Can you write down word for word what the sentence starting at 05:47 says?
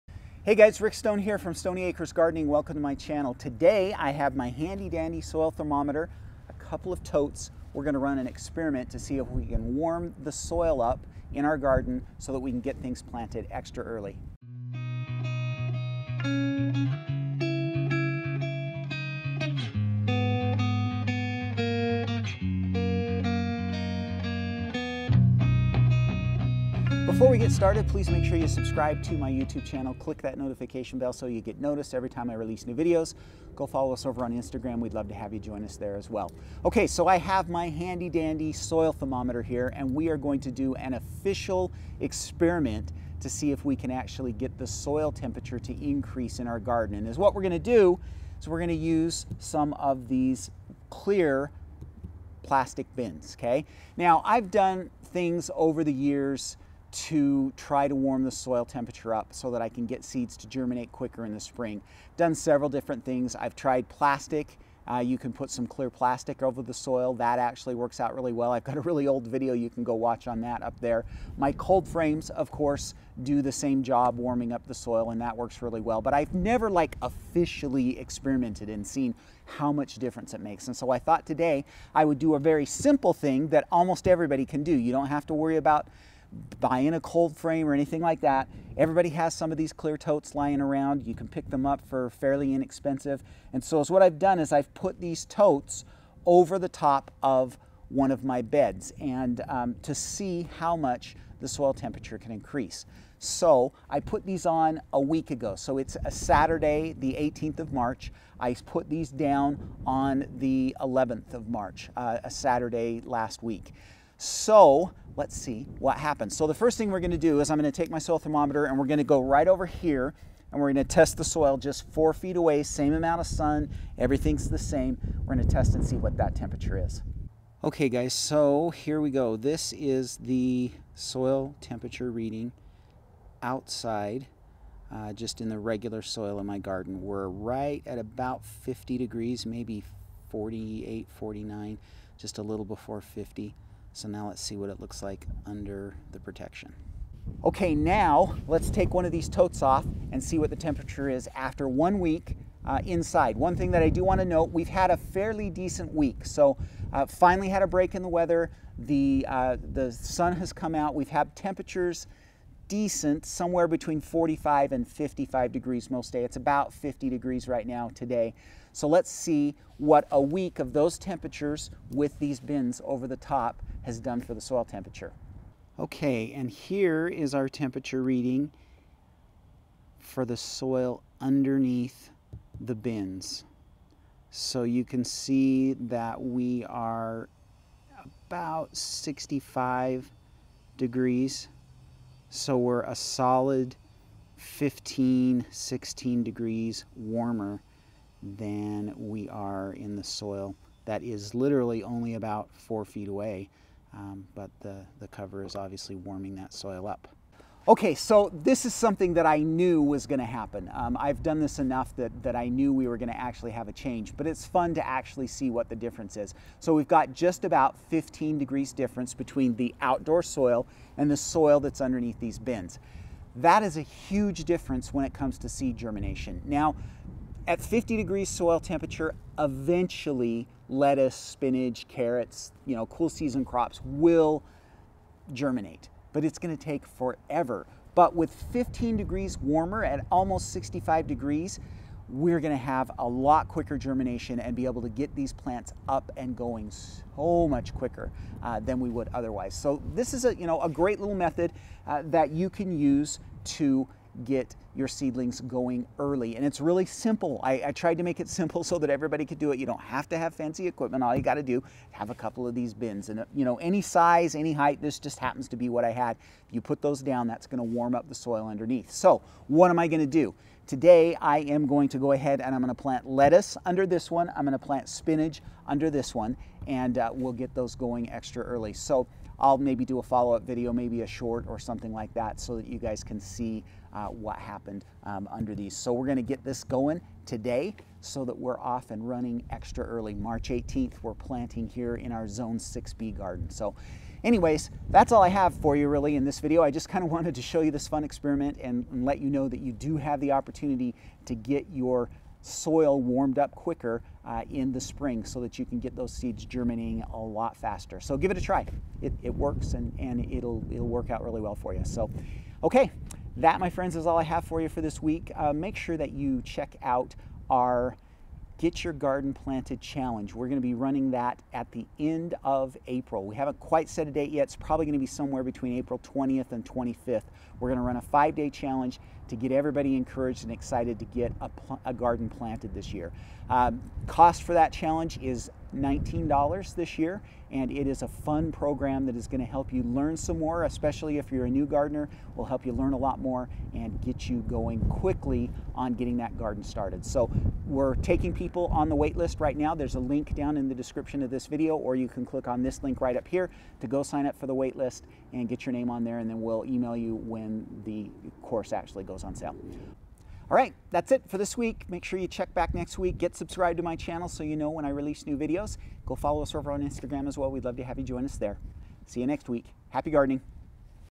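So we're taking people on the wait list right now.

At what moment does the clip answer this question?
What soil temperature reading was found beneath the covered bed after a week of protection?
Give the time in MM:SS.
03:08.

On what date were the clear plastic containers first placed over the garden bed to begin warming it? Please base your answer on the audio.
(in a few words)
11th of March.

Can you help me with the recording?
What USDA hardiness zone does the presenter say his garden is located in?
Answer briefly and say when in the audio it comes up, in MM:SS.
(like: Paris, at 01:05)
Zone 6B, at 04:52.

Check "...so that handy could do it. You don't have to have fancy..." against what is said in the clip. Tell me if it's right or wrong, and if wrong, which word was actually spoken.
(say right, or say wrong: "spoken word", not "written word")
wrong: "everybody", not "handy".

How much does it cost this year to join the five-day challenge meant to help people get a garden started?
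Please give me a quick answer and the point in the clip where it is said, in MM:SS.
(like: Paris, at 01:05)
$19, at 05:35.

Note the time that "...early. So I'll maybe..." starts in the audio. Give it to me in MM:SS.
04:38.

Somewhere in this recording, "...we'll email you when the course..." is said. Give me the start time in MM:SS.
05:56.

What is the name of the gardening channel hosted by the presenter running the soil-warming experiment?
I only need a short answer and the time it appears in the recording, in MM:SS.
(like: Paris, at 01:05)
Stoney Acres Gardening, at 00:01.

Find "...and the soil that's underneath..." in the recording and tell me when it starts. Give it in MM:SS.
03:40.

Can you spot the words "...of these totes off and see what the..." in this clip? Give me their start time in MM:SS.
02:29.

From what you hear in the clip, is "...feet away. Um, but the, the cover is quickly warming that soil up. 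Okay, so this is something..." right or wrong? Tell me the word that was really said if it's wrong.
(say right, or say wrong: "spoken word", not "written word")
wrong: "obviously", not "quickly".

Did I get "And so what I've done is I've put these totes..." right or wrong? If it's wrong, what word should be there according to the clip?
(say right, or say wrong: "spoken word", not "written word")
right.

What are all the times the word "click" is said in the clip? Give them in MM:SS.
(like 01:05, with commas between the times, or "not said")
00:29, 05:52.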